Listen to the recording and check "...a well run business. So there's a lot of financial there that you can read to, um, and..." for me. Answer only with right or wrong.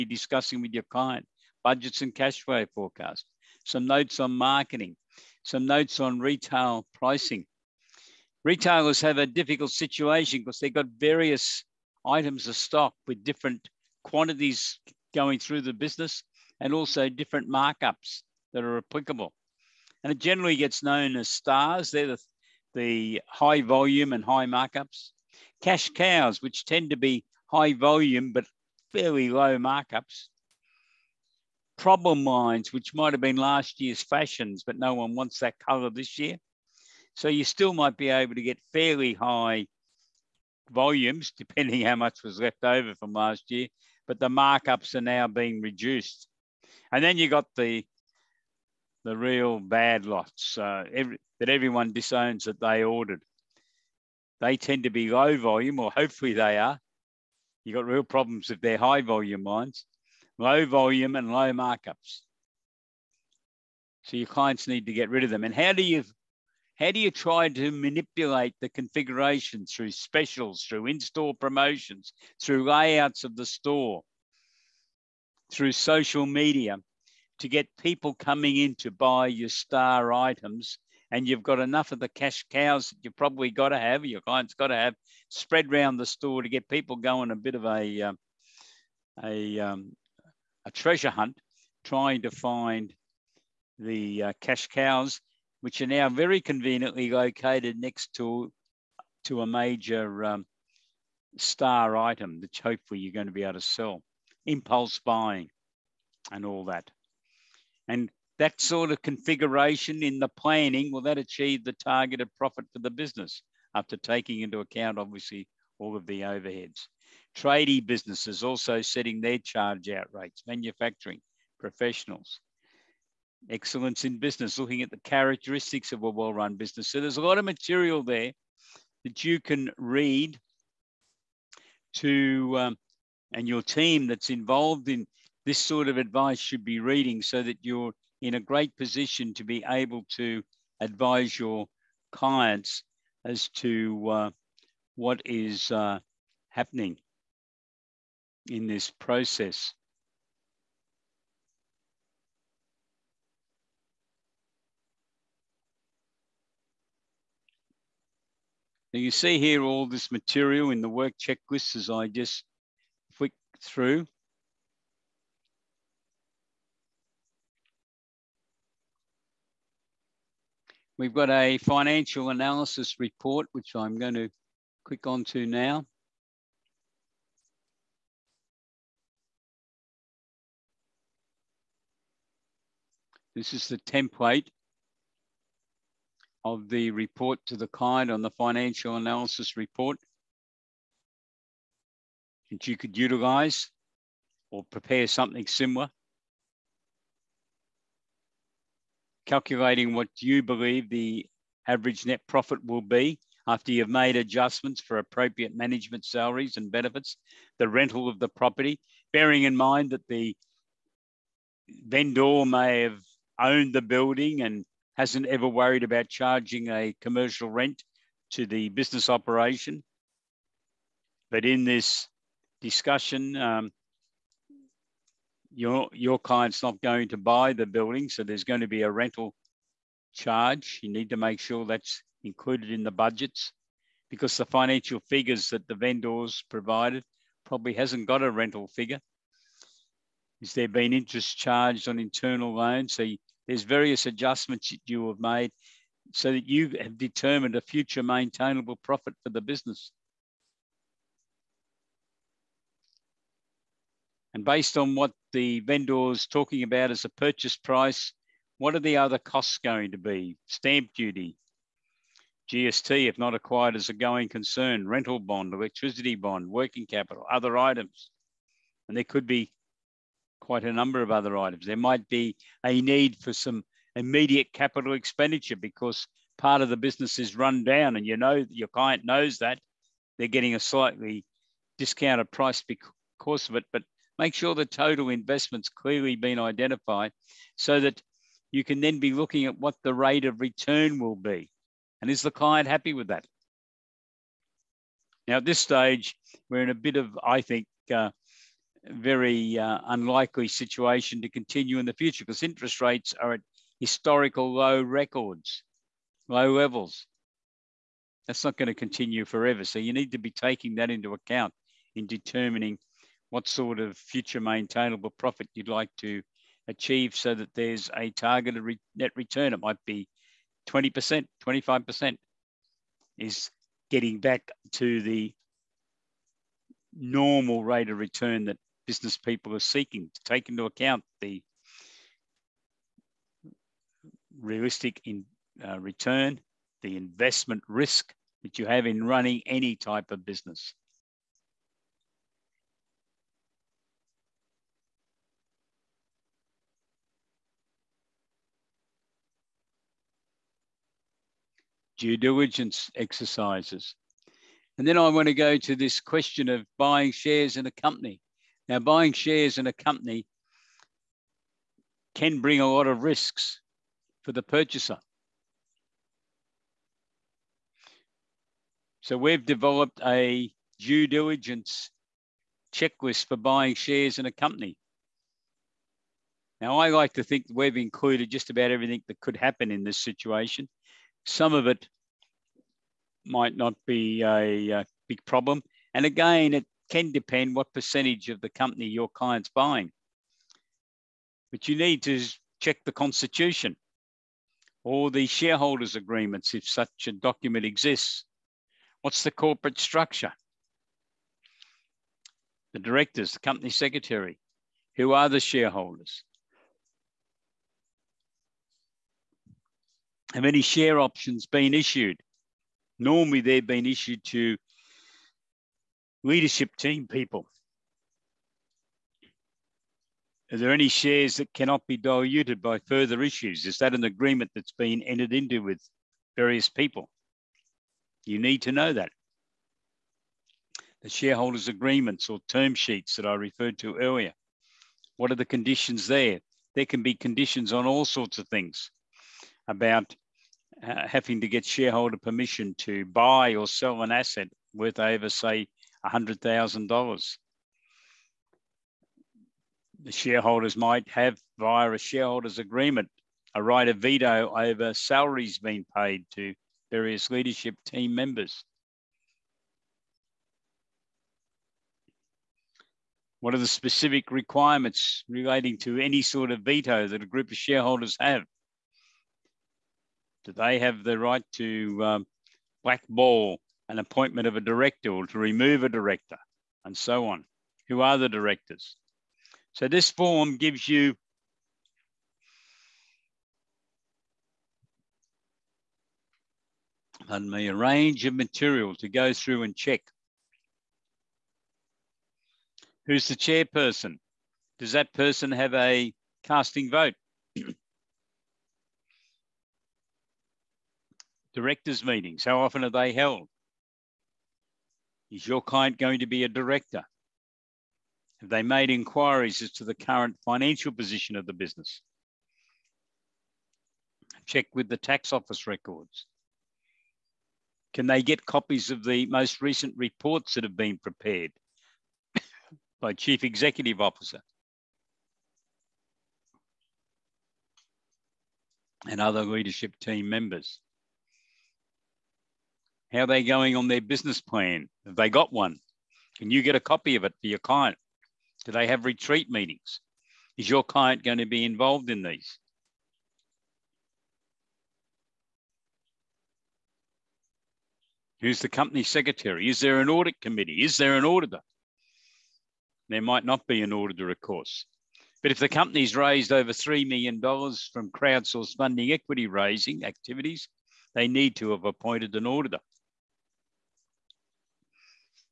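wrong.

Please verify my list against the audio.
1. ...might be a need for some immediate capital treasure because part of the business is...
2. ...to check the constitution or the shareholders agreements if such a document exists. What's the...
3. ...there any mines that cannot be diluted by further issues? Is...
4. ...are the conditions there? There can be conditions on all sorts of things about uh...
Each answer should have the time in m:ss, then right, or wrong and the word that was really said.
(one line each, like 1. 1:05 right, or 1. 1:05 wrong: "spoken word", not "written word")
1. 4:31 wrong: "expenditure", not "treasure"
2. 6:32 right
3. 7:00 wrong: "shares", not "mines"
4. 7:15 right.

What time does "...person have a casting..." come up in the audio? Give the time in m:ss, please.
8:15.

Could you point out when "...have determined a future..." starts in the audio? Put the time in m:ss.
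4:06.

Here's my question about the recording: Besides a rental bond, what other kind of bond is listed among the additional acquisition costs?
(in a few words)
Electricity bond.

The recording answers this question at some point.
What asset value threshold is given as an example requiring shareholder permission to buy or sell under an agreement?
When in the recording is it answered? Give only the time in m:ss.
7:26.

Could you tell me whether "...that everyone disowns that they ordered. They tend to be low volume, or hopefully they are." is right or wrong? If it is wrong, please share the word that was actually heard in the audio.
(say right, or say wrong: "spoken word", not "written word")
right.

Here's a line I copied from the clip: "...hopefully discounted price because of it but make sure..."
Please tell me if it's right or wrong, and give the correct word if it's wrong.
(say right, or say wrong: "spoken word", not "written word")
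wrong: "slightly", not "hopefully".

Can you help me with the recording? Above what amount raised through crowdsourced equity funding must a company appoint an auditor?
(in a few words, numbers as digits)
$3 million.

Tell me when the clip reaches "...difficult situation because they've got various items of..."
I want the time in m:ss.
0:09.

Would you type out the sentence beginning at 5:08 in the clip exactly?
That's not going to continue forever.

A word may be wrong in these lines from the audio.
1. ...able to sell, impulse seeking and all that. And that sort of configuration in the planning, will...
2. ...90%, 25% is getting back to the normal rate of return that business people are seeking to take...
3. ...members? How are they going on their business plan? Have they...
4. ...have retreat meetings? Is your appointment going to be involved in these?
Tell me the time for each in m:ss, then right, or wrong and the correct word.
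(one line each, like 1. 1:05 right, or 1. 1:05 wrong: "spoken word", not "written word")
1. 1:43 wrong: "buying", not "seeking"
2. 5:20 wrong: "20", not "90"
3. 8:50 right
4. 8:58 wrong: "client", not "appointment".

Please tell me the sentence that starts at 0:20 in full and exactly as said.
And it generally gets known as stars.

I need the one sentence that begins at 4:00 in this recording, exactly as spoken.
Is there been interest charged on internal loans?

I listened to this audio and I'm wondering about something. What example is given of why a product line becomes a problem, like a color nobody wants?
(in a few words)
Last year's fashions.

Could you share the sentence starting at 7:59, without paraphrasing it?
So this form gives you pardon me, a range of material to go through and check.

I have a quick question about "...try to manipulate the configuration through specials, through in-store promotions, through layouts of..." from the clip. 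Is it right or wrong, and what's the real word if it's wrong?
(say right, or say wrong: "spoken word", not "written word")
right.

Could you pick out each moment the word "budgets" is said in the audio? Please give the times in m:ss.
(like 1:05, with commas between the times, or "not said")
0:01, 3:52.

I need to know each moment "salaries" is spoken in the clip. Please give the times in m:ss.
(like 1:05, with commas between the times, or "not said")
3:26, 7:34.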